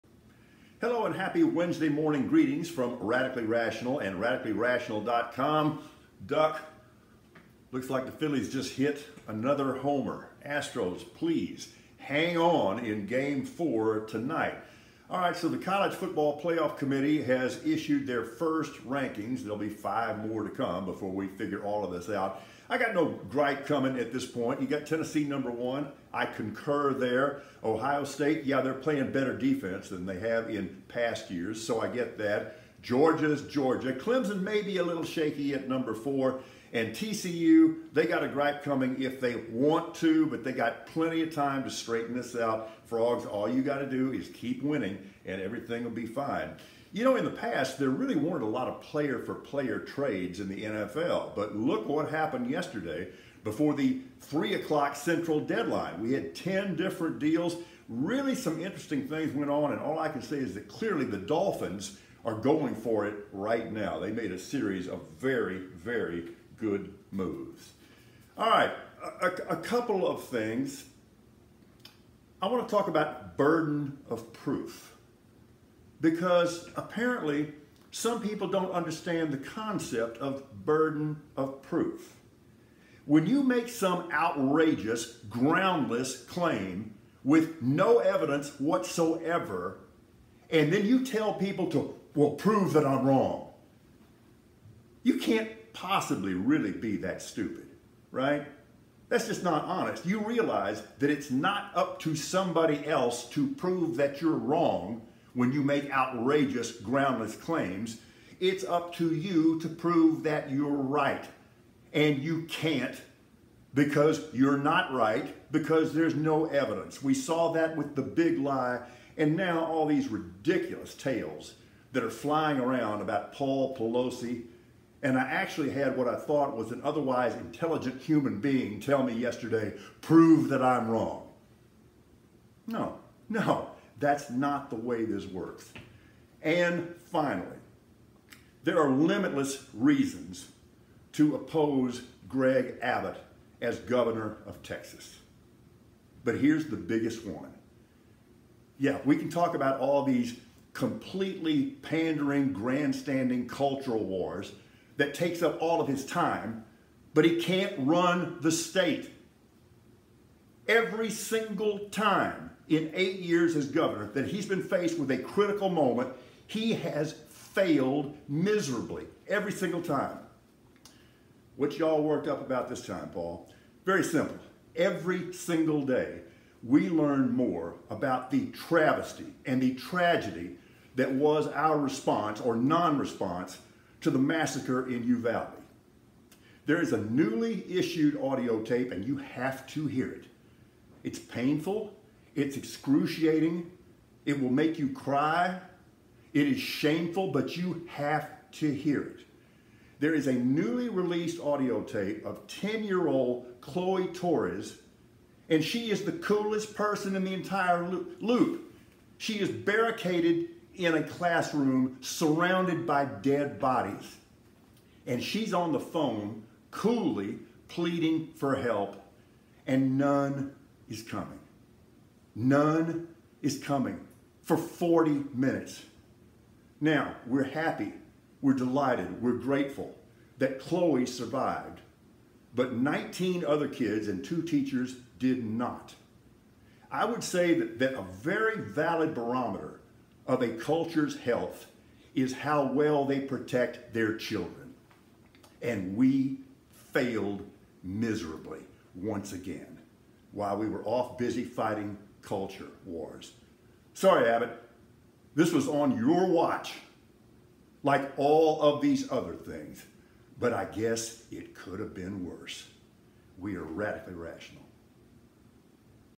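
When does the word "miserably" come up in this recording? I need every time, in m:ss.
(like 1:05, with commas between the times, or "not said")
2:48, 4:07.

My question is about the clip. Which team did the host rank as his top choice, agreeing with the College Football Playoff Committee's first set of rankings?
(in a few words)
Tennessee.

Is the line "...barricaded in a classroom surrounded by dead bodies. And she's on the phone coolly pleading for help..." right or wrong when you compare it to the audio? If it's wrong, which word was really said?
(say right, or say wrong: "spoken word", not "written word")
right.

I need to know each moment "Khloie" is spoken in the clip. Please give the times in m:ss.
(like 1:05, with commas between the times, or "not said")
3:23, 3:50.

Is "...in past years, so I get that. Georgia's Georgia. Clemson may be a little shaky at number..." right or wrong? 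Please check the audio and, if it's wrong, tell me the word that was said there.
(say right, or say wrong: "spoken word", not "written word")
right.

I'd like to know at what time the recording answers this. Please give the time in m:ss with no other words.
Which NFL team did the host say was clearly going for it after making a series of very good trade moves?
1:01.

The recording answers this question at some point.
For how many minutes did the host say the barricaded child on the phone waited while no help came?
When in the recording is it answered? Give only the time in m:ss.
3:44.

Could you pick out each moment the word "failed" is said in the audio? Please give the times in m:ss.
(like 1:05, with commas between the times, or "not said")
2:47, 4:06.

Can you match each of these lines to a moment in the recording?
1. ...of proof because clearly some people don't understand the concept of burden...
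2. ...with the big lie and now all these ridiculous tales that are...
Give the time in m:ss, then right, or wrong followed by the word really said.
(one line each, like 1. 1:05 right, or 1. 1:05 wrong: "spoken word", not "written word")
1. 1:14 wrong: "apparently", not "clearly"
2. 1:57 right.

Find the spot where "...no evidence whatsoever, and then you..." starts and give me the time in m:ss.
1:27.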